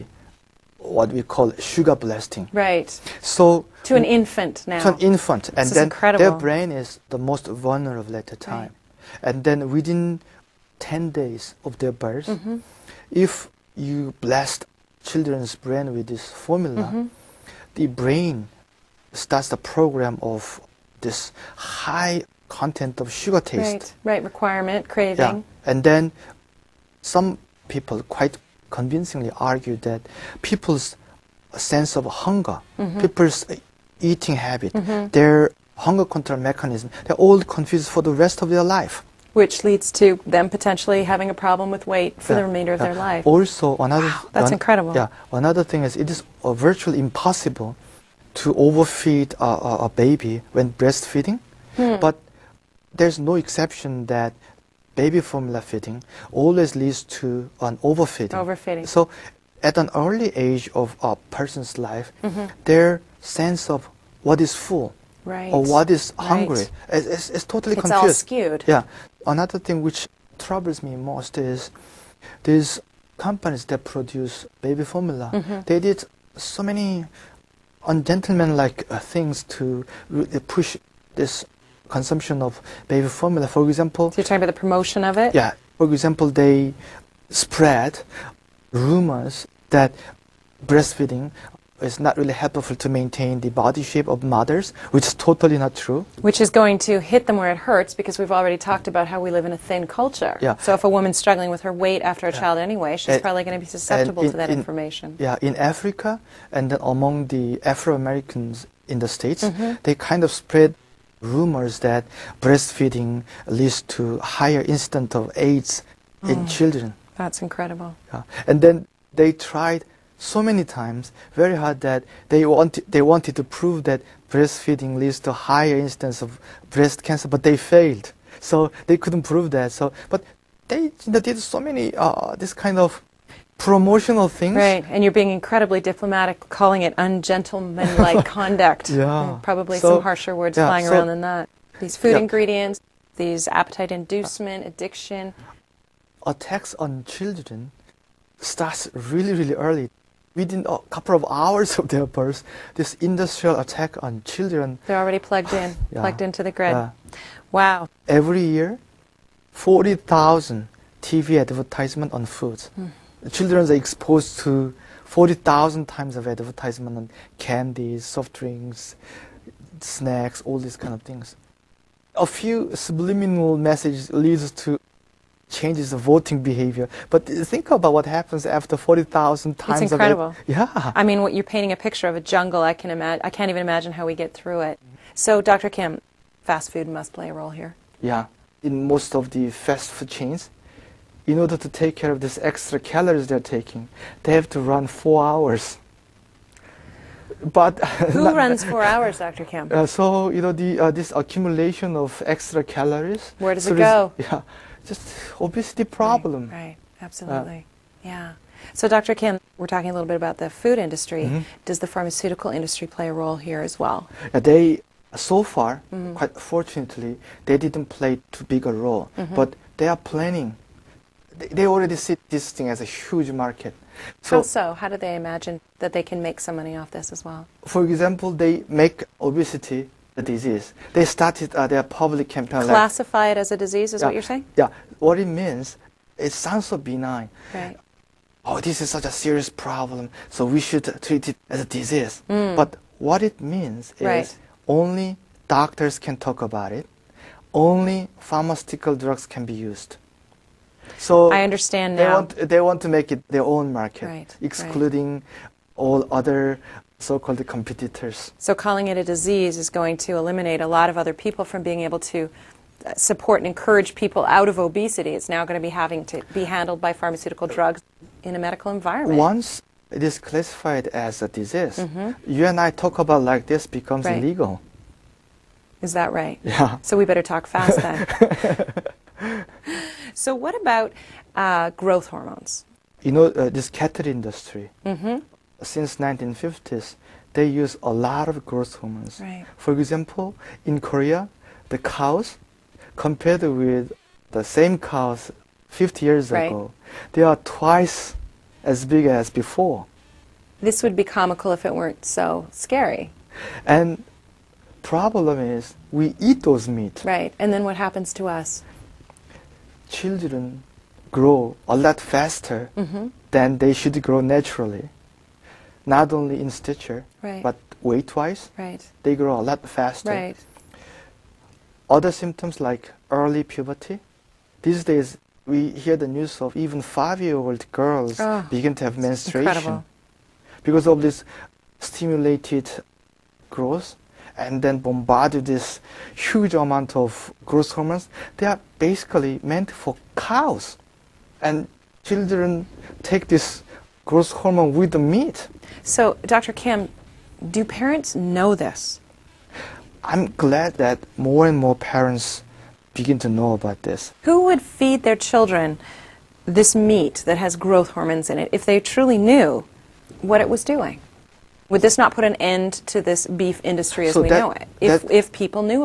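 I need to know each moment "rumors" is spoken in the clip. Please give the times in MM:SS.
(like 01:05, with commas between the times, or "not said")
01:28, 01:51.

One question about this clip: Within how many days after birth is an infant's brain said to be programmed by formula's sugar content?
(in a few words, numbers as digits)
10 days.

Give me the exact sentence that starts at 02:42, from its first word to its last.
Mm children are exposed to 40,000 times of advertisement on candies, soft drinks, snacks, all these kind of things.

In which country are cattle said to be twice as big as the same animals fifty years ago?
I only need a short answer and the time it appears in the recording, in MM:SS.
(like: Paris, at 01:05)
Korea, at 04:50.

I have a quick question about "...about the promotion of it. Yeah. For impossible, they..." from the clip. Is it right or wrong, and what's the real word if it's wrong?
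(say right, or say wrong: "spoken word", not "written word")
wrong: "example", not "impossible".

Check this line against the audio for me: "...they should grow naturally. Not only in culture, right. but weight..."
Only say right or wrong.
wrong.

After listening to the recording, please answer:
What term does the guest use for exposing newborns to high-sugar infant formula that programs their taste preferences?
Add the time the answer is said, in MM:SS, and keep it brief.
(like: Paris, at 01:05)
sugar blasting, at 00:01.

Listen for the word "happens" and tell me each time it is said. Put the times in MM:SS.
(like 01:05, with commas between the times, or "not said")
02:58, 05:07.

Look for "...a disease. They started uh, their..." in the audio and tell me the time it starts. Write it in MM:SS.
03:50.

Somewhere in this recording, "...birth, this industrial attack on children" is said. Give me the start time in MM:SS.
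02:32.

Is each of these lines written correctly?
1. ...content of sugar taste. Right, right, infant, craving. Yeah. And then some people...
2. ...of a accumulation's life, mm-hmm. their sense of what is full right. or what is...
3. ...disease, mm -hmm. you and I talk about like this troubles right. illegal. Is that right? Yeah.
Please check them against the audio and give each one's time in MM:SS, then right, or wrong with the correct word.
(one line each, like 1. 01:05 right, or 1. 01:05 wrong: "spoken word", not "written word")
1. 00:22 wrong: "requirement", not "infant"
2. 01:00 wrong: "person", not "accumulation"
3. 04:31 wrong: "becomes", not "troubles".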